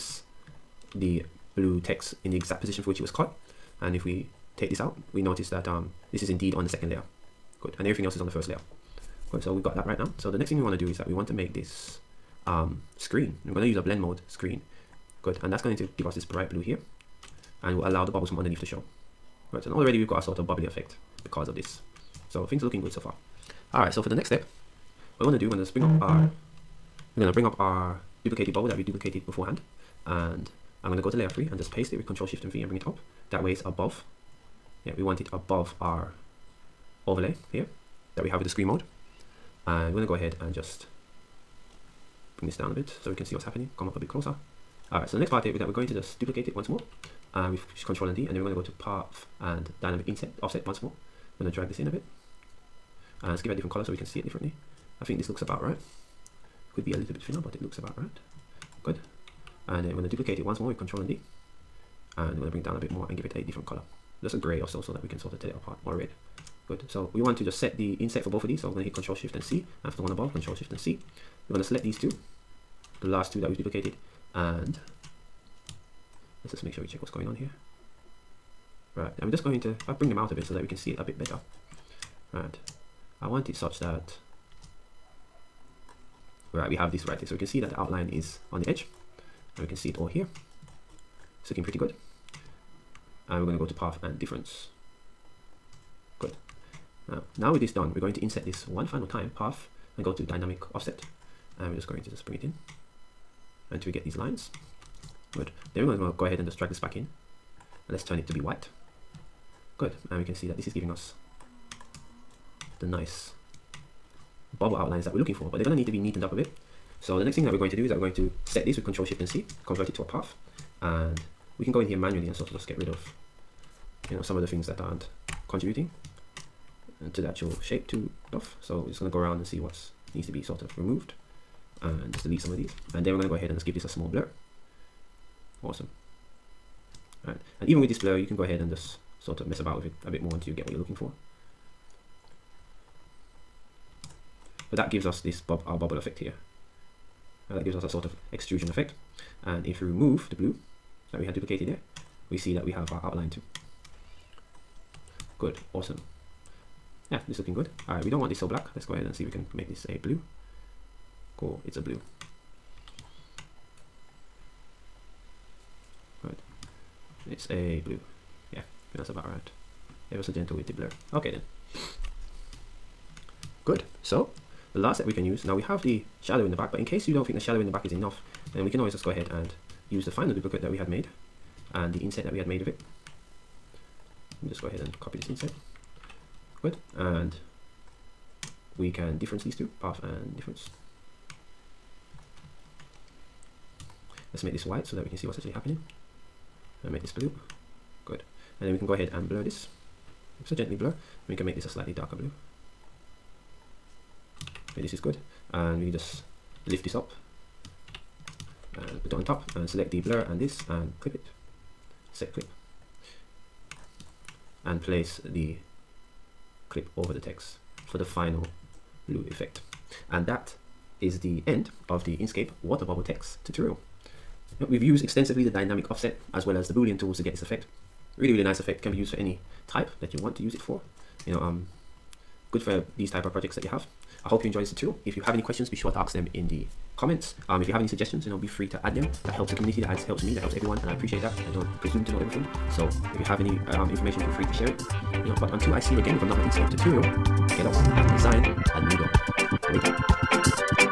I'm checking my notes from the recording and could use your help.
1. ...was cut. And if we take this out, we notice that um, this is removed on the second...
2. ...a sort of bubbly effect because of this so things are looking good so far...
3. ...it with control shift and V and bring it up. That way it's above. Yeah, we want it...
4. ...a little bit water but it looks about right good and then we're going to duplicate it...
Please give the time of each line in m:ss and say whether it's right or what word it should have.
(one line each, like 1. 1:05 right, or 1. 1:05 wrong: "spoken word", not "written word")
1. 0:03 wrong: "indeed", not "removed"
2. 0:20 right
3. 0:31 right
4. 0:56 wrong: "thinner", not "water".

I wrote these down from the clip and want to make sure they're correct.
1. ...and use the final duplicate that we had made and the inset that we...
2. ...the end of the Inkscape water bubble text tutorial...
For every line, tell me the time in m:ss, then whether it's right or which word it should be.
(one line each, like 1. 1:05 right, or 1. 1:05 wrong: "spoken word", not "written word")
1. 2:59 right
2. 3:41 right.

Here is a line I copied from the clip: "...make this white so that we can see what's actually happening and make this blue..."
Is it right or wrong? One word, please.
right.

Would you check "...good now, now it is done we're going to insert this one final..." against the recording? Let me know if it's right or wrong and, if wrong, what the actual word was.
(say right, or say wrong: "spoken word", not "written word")
right.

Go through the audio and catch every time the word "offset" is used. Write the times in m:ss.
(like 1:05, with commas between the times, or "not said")
0:50, 1:40, 3:45.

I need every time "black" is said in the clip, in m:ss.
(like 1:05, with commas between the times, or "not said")
2:38.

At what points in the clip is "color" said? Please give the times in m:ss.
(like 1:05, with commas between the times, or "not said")
0:53, 1:03.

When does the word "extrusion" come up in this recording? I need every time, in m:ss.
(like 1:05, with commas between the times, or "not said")
2:28.